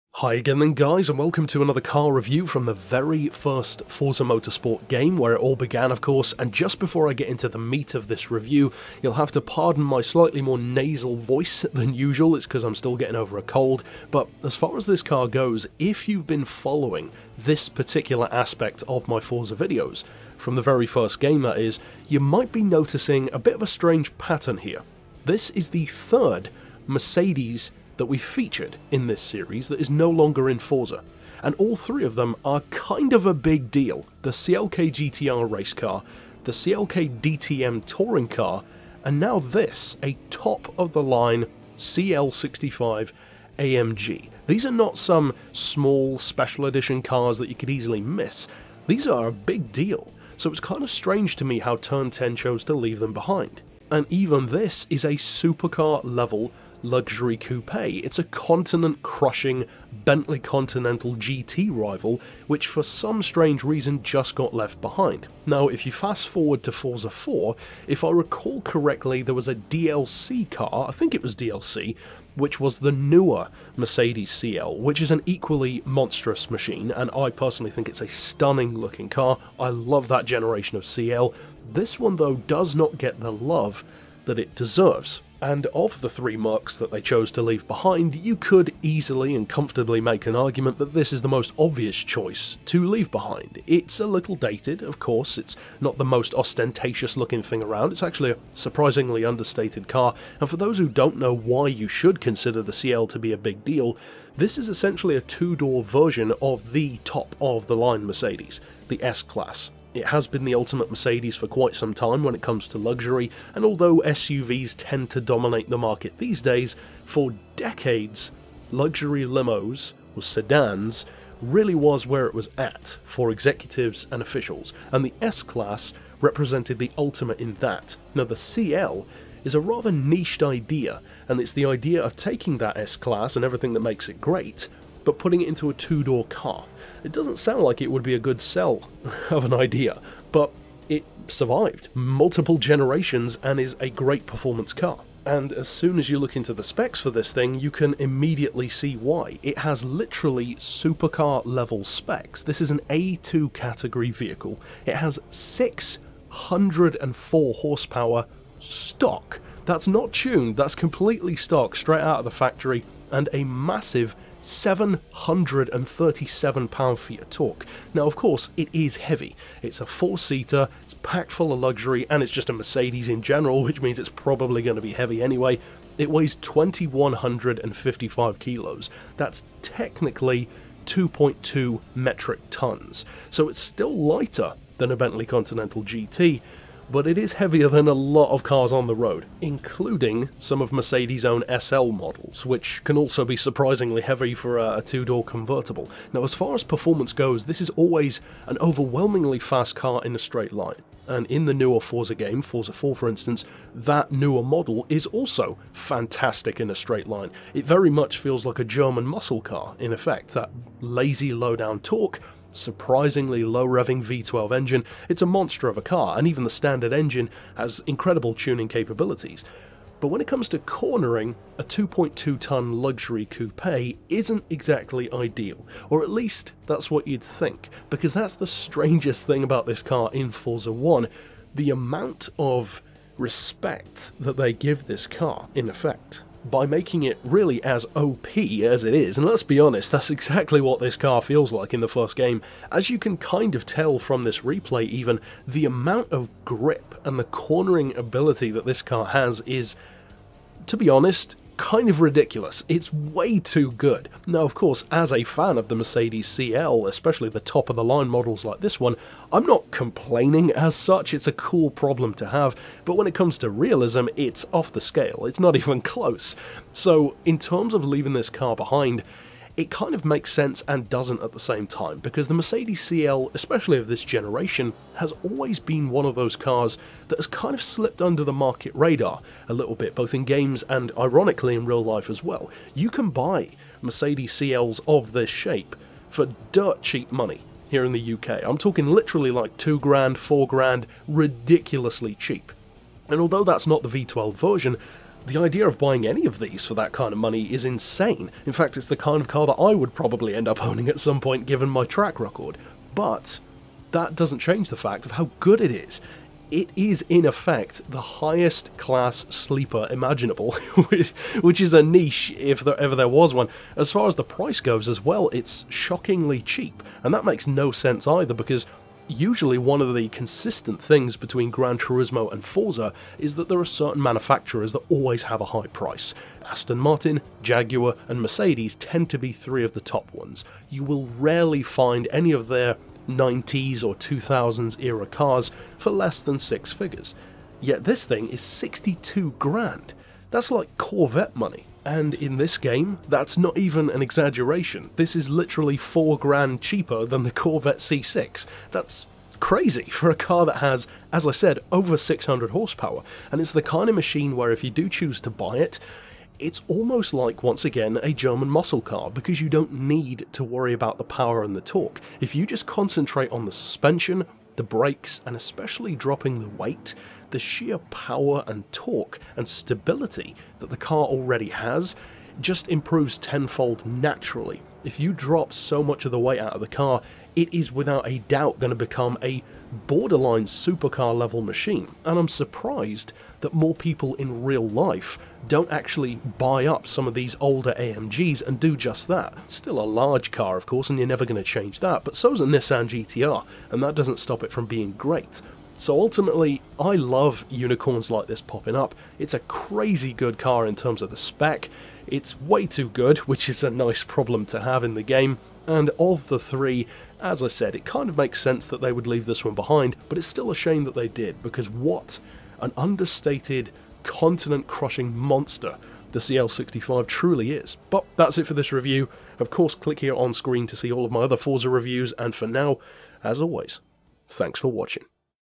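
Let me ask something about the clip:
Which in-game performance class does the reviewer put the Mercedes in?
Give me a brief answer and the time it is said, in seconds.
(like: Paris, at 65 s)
A2, at 152 s.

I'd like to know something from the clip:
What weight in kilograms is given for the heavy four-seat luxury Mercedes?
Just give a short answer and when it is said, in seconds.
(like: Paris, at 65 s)
2,155 kg, at 176 s.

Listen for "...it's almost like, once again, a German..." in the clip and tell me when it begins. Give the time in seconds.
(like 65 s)
356 s.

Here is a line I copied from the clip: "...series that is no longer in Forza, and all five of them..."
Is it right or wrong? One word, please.
wrong.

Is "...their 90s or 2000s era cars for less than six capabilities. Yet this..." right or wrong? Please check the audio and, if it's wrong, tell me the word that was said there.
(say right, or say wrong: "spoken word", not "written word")
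wrong: "figures", not "capabilities".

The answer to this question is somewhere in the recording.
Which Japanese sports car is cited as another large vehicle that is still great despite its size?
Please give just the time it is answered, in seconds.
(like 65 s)
392 s.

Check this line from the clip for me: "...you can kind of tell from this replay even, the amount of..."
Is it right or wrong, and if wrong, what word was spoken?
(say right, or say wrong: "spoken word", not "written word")
right.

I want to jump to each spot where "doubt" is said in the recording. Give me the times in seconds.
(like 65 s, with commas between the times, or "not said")
378 s.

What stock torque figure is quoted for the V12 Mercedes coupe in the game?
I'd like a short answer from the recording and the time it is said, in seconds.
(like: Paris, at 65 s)
737 lb-ft, at 164 s.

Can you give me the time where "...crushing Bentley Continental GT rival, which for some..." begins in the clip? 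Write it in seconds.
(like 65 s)
59 s.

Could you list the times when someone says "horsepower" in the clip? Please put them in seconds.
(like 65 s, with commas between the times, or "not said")
157 s, 352 s.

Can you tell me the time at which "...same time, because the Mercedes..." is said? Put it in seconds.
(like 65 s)
271 s.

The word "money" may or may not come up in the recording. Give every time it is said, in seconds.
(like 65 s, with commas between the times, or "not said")
287 s, 297 s, 341 s.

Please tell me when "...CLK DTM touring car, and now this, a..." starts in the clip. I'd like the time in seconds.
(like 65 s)
36 s.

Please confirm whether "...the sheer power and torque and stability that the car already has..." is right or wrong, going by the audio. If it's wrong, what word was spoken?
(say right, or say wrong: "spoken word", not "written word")
right.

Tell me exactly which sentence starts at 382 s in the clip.
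And I'm surprised that more people in real life don't actually buy up some of these older AMGs and do just that.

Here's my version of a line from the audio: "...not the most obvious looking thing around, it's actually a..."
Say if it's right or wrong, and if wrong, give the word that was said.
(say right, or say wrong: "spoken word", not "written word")
wrong: "ostentatious", not "obvious".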